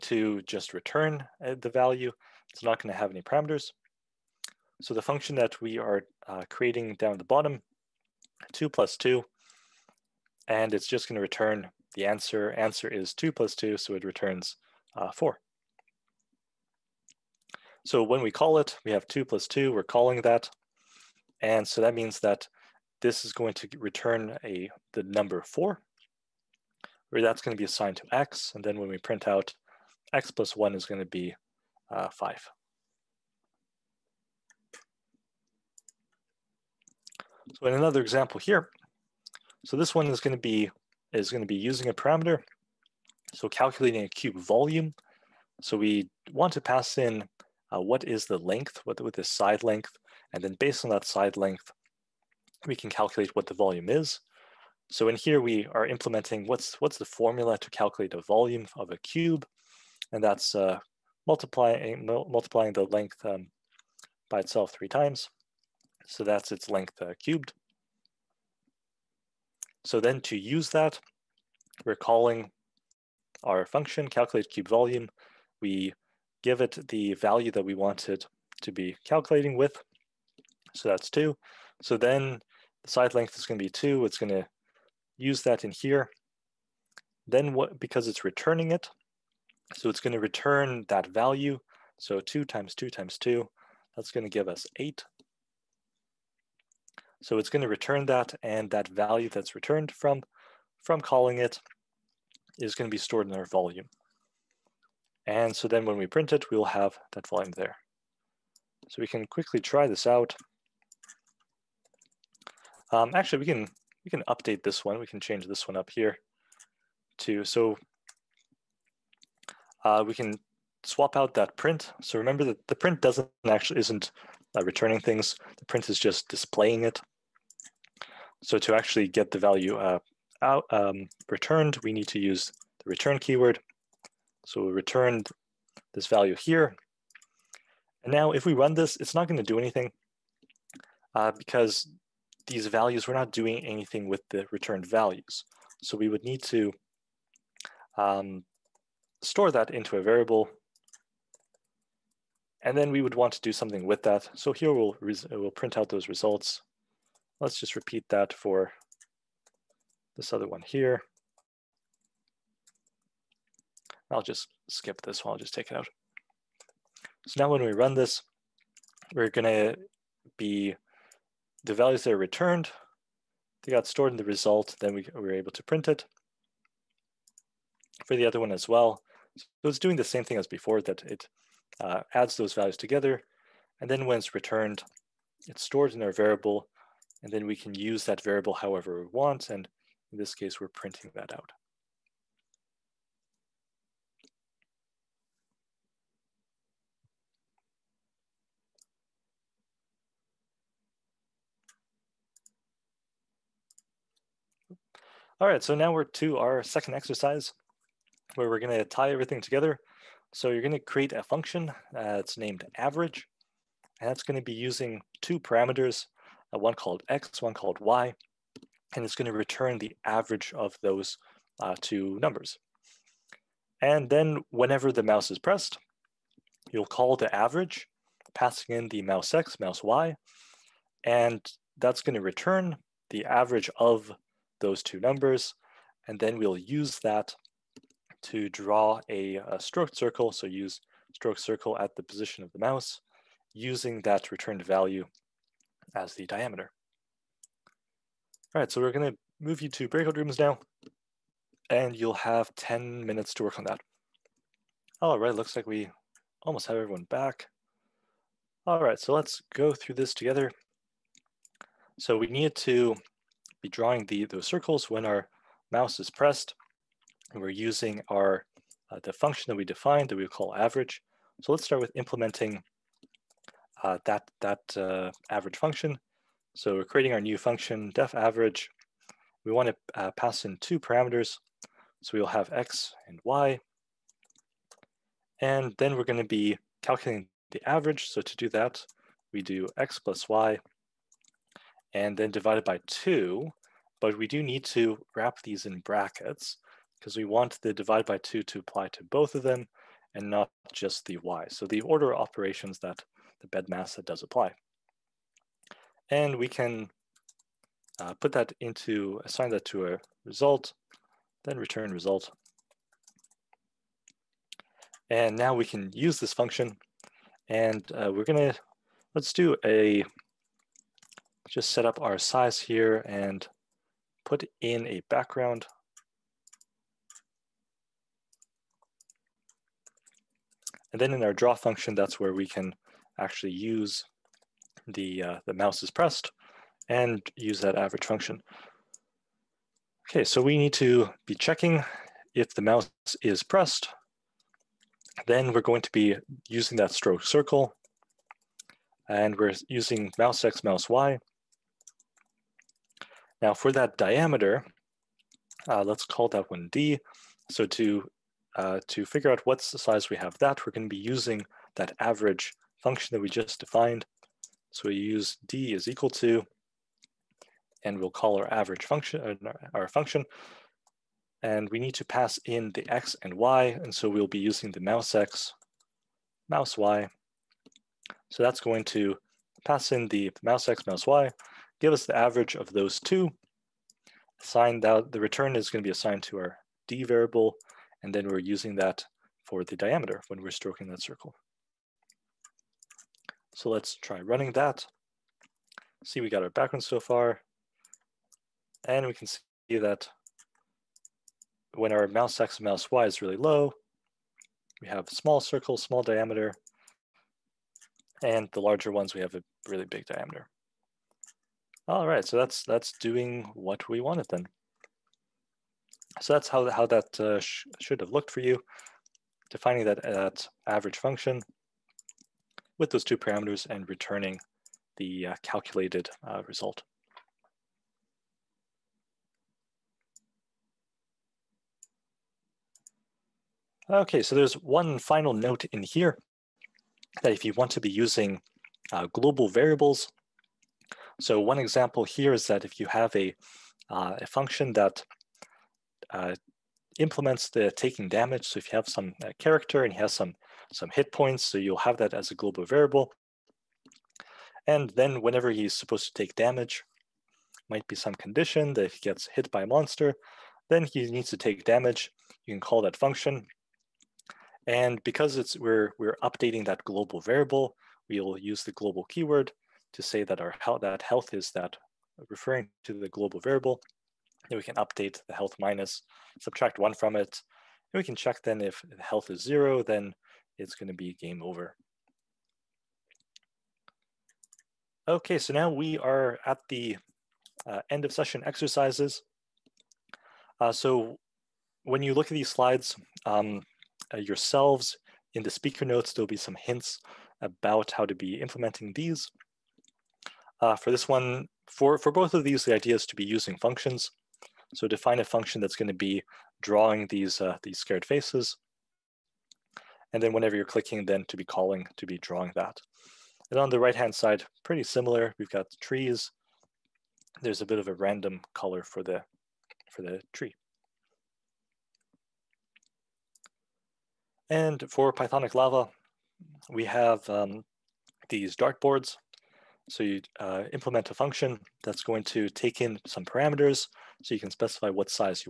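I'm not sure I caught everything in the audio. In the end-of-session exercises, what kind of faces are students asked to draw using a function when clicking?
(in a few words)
scared faces.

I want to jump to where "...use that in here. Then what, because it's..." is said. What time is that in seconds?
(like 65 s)
85 s.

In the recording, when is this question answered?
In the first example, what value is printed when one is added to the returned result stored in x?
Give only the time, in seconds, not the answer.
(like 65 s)
32 s.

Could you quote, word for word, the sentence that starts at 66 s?
So that's its length uh, cubed.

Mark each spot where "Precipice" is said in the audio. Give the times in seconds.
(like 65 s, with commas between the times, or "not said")
not said.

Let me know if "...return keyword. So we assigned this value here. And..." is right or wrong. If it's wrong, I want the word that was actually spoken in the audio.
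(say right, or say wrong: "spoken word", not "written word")
wrong: "returned", not "assigned".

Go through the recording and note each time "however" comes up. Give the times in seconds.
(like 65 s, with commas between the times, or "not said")
188 s.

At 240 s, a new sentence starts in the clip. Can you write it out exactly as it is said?
So use stroke circle at the position of the mouse using that returned value as the diameter.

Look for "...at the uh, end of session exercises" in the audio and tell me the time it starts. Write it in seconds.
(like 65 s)
486 s.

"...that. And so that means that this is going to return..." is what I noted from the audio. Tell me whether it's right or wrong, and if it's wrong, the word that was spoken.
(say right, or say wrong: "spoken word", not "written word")
right.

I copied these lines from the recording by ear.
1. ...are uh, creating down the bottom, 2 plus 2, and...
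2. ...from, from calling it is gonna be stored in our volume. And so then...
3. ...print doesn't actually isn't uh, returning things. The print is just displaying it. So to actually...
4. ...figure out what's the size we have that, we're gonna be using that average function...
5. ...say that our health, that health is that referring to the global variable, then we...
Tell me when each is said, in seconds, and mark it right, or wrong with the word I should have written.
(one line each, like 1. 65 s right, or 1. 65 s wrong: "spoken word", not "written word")
1. 5 s right
2. 99 s right
3. 122 s right
4. 359 s right
5. 470 s right.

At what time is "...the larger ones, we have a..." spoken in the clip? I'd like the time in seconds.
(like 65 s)
408 s.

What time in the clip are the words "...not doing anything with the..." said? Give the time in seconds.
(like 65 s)
143 s.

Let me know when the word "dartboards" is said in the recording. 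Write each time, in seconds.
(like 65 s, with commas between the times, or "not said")
528 s.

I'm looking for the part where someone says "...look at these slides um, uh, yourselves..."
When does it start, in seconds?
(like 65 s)
492 s.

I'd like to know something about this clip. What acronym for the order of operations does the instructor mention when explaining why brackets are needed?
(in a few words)
BEDMAS.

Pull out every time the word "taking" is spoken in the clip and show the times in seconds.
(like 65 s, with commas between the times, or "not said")
447 s.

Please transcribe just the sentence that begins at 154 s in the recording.
So here we'll, we'll print out those results.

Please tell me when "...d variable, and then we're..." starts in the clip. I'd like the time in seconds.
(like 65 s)
386 s.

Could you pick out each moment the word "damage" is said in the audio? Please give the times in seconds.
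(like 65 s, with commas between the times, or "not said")
448 s, 456 s, 461 s.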